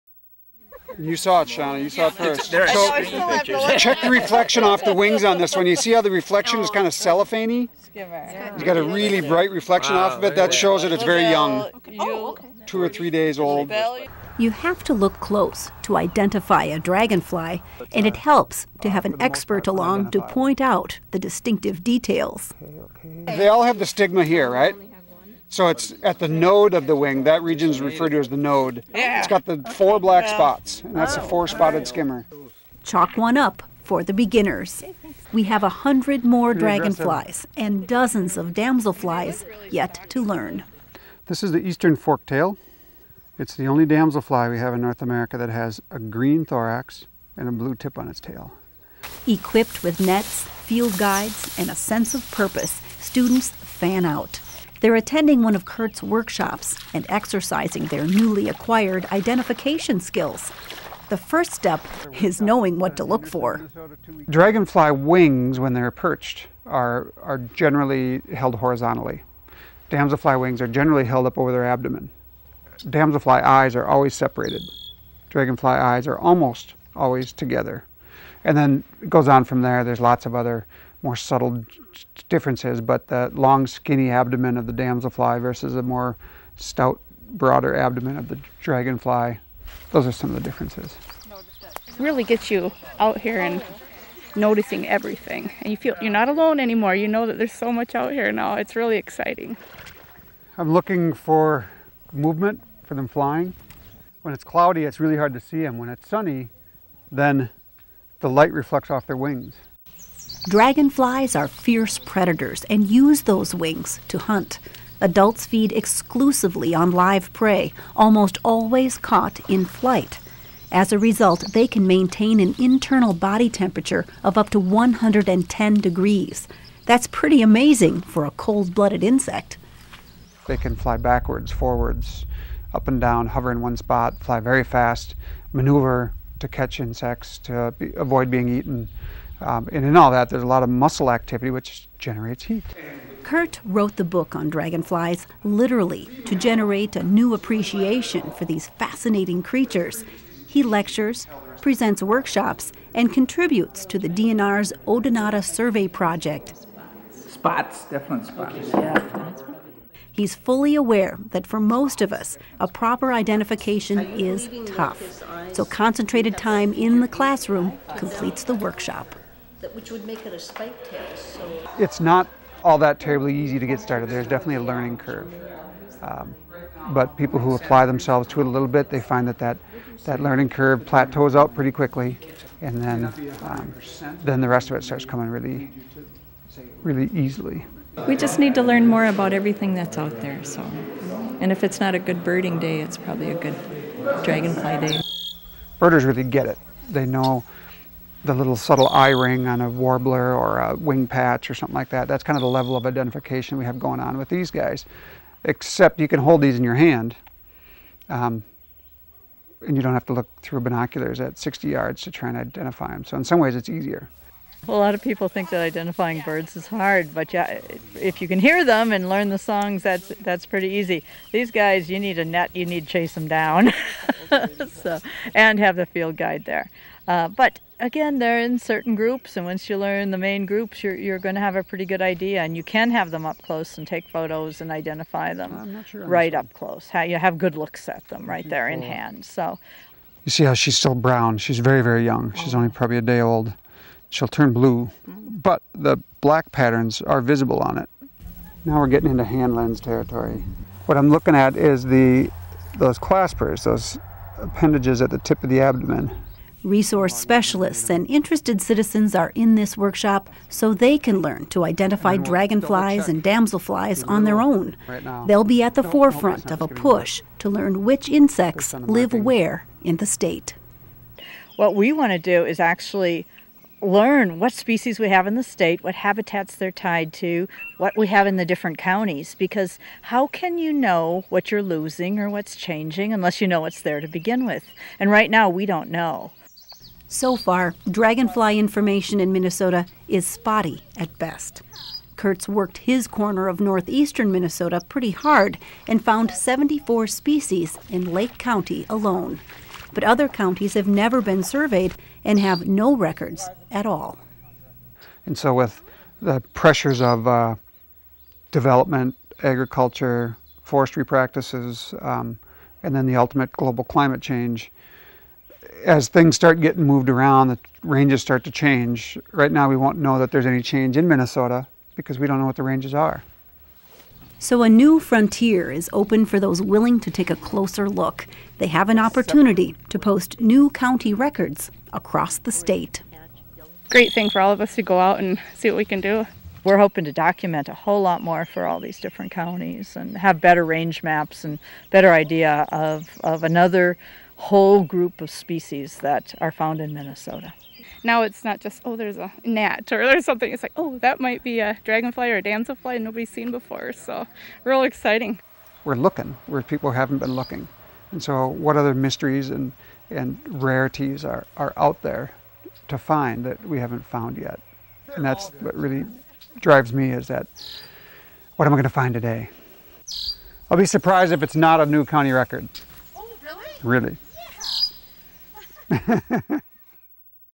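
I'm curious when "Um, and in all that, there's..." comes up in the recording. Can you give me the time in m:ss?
2:19.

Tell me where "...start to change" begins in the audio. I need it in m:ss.
5:18.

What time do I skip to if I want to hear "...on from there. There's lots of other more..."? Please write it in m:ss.
1:19.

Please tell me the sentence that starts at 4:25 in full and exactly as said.
They'll be at the forefront of a push to learn which insects live where in the state.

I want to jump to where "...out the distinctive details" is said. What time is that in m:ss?
0:20.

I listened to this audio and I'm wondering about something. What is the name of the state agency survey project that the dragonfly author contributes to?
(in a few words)
Odonata Survey Project.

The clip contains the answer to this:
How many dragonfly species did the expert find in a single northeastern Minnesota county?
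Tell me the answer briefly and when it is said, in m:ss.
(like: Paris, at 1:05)
74, at 4:56.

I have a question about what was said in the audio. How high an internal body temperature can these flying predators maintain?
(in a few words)
110 degrees.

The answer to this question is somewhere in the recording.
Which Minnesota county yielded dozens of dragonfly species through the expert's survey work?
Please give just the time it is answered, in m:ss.
4:58.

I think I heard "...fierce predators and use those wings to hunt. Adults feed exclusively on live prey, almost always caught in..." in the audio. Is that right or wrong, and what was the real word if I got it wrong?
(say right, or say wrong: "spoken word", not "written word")
right.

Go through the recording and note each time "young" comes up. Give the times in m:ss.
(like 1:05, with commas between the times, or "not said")
0:11, 4:02.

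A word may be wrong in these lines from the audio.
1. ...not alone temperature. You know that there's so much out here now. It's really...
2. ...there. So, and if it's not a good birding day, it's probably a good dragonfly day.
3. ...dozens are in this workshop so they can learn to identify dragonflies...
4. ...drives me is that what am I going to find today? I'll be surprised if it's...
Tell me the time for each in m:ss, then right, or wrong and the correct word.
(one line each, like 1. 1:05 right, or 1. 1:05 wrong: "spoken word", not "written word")
1. 1:36 wrong: "anymore", not "temperature"
2. 3:10 right
3. 4:18 wrong: "citizens", not "dozens"
4. 6:06 right.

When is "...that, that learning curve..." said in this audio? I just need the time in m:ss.
2:59.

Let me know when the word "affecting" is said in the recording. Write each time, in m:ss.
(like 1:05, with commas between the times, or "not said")
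not said.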